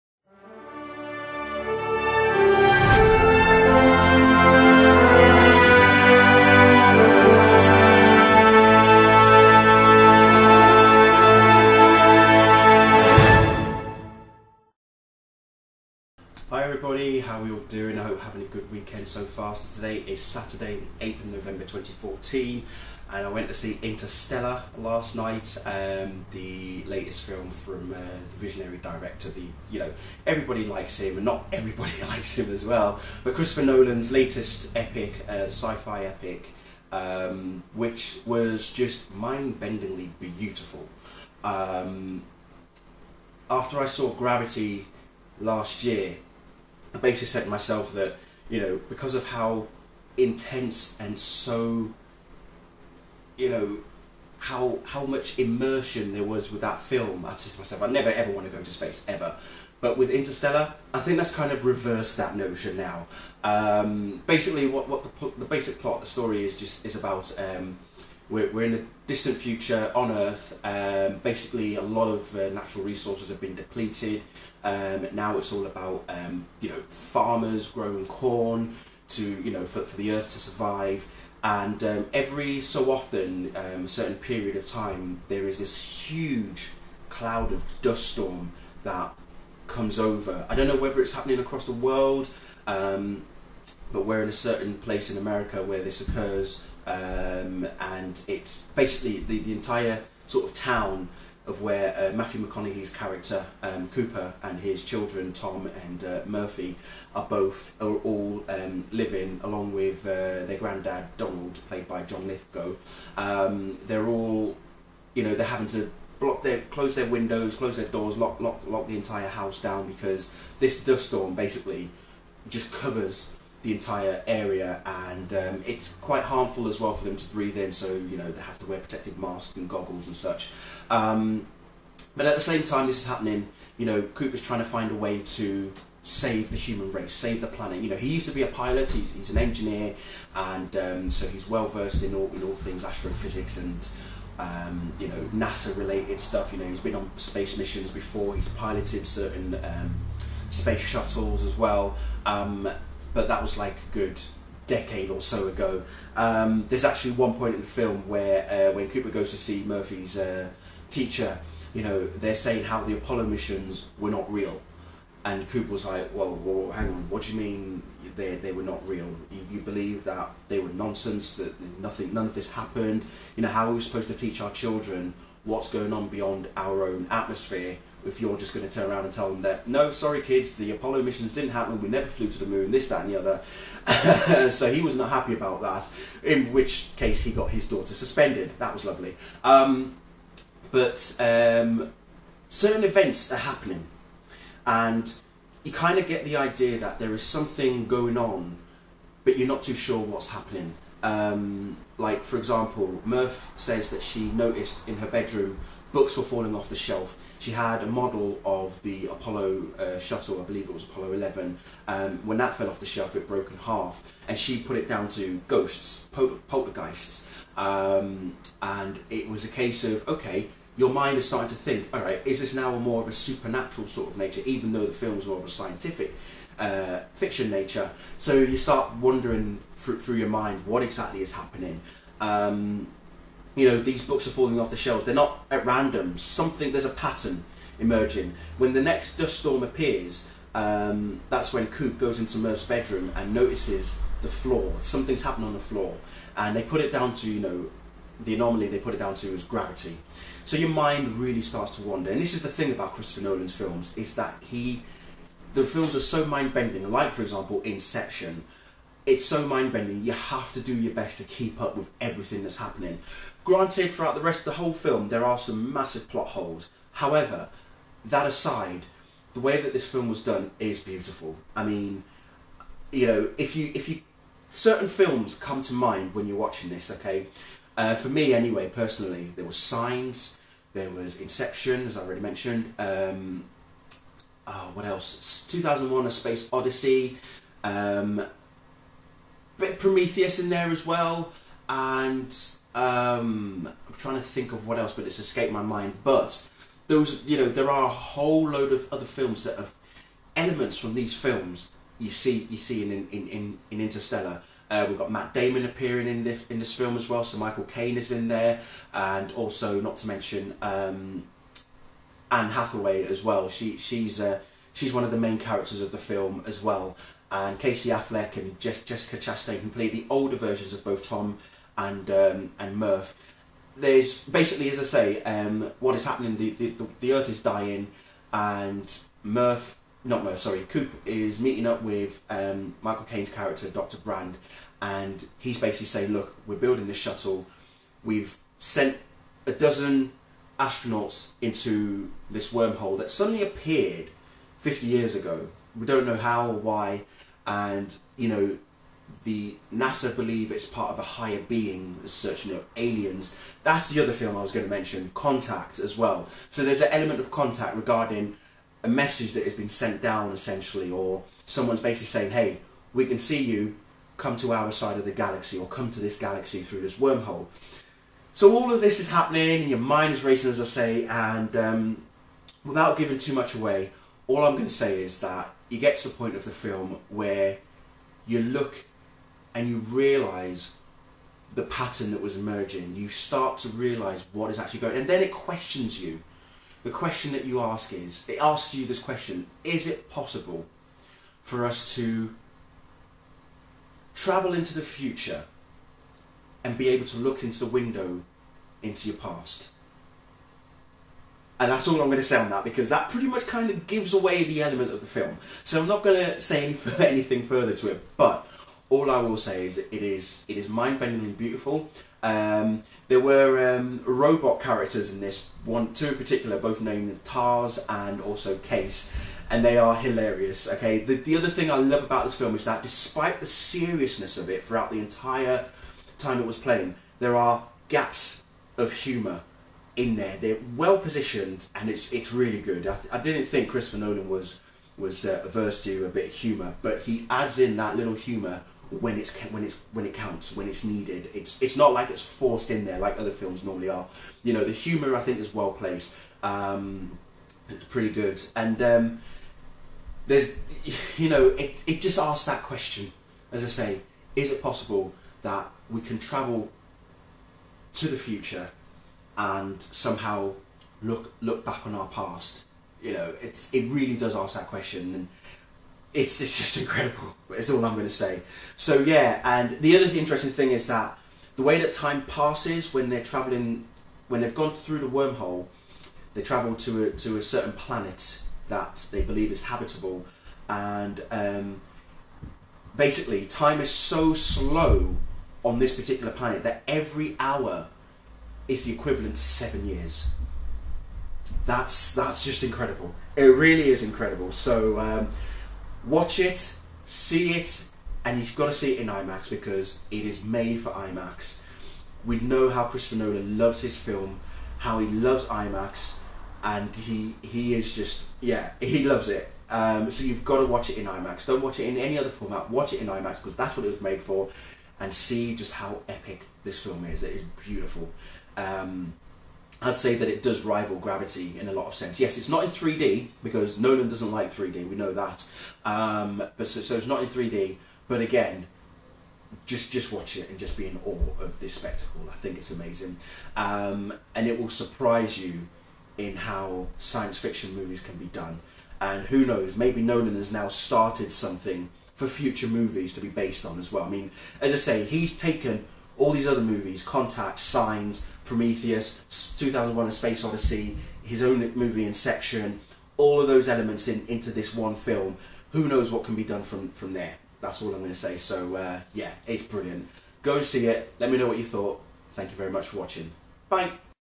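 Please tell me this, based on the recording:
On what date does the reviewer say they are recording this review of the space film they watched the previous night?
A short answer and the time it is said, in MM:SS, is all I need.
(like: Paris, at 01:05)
8th of November 2014, at 00:20.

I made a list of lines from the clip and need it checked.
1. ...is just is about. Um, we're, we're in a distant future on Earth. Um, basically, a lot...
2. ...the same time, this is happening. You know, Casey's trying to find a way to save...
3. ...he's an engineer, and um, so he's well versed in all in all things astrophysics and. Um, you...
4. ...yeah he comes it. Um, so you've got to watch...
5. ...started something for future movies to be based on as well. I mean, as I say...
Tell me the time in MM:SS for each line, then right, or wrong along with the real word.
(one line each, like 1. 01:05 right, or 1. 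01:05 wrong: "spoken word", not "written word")
1. 01:06 right
2. 02:12 wrong: "Cooper", not "Casey"
3. 02:19 right
4. 08:28 wrong: "loves", not "comes"
5. 09:00 right.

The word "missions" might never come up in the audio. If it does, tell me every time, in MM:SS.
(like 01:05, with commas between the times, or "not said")
02:27, 02:43, 03:01.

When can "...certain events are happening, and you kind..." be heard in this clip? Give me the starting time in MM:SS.
03:12.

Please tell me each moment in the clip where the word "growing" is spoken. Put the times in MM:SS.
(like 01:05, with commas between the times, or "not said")
01:17.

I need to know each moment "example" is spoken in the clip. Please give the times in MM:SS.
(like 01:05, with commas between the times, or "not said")
03:22, 04:17.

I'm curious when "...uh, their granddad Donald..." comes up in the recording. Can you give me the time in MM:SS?
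01:50.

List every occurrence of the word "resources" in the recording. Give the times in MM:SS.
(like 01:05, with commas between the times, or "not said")
01:12.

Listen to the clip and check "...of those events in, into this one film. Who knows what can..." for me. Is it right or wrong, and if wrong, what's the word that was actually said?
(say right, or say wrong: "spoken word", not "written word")
wrong: "elements", not "events".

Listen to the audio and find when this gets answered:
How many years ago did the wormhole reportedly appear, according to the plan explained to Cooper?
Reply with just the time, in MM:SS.
05:44.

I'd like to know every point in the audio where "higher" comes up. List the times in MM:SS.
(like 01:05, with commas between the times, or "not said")
05:51.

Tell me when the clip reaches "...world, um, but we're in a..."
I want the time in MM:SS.
01:31.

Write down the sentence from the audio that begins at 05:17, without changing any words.
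And Casey Affleck and Jessica Chastain, who play the older versions of both Tom and um, and Murph.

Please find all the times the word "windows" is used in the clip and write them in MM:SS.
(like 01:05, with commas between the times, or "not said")
01:57, 06:37.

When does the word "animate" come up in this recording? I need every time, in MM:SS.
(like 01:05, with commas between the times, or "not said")
not said.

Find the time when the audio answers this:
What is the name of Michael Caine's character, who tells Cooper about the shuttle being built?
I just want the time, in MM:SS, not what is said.
05:33.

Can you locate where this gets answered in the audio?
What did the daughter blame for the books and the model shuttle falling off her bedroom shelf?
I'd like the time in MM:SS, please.
03:35.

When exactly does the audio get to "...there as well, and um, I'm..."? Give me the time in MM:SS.
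04:50.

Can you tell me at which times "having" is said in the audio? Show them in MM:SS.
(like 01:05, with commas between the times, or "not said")
00:18, 01:55.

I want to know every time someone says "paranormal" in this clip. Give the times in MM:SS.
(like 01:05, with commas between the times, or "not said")
not said.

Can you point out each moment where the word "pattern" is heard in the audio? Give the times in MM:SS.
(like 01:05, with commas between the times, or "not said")
03:56, 06:21.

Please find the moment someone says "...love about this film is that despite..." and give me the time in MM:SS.
07:01.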